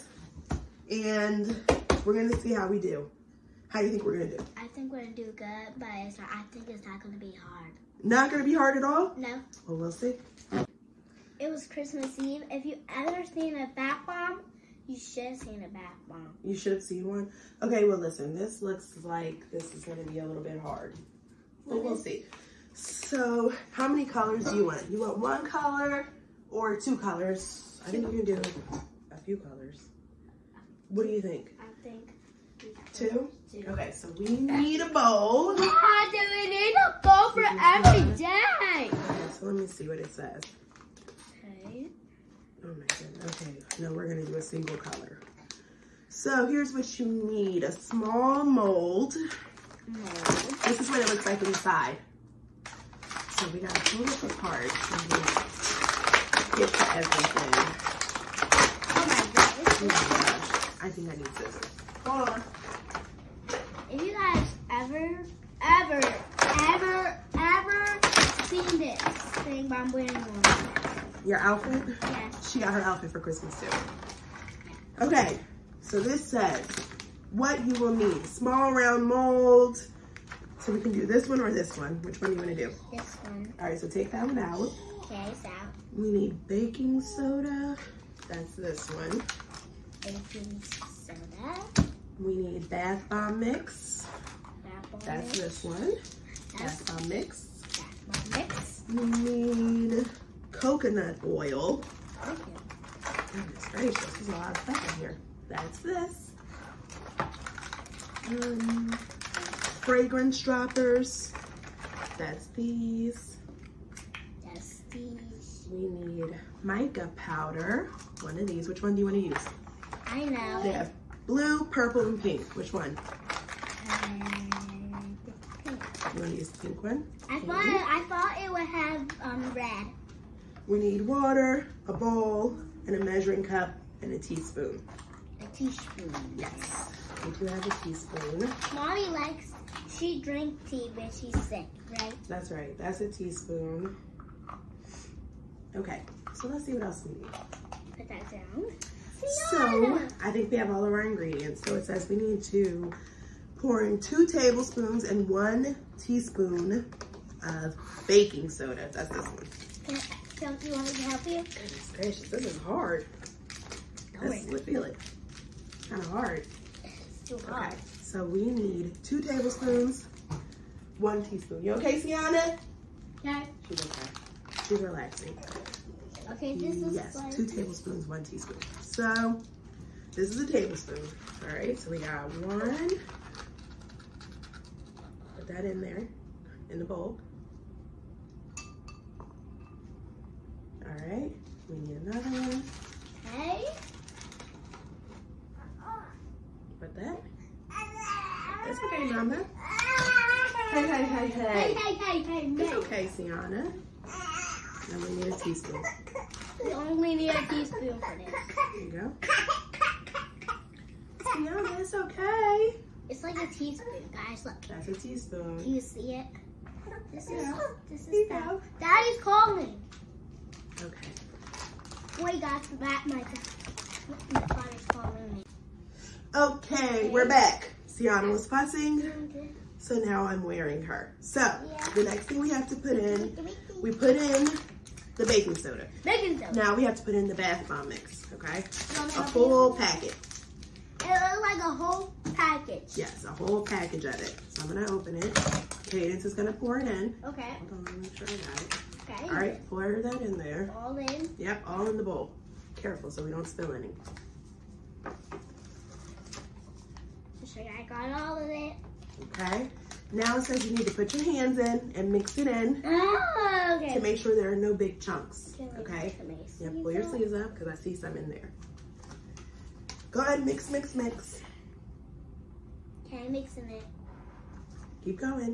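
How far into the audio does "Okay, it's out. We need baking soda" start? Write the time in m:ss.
1:25.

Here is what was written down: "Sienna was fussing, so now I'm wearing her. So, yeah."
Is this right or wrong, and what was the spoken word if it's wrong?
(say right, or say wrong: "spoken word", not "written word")
right.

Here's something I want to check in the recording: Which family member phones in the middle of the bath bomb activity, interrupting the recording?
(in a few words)
Dad.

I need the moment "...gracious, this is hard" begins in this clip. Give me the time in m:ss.
2:41.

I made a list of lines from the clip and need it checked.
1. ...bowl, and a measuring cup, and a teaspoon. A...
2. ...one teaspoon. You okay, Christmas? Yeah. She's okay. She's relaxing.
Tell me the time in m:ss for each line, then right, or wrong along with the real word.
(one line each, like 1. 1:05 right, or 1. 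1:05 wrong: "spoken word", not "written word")
1. 2:11 right
2. 2:50 wrong: "Sienna", not "Christmas".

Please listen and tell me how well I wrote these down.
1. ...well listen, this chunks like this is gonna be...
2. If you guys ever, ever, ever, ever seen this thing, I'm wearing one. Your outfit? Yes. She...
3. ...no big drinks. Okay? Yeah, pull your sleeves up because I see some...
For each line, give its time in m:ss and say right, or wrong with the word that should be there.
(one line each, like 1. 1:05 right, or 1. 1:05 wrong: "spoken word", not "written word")
1. 0:17 wrong: "looks", not "chunks"
2. 1:03 right
3. 4:24 wrong: "chunks", not "drinks".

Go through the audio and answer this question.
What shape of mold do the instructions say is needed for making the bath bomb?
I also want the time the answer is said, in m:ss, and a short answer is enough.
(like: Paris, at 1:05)
Small round mold, at 1:18.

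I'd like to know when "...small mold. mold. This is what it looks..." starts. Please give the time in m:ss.
0:47.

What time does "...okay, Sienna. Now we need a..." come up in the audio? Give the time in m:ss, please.
3:22.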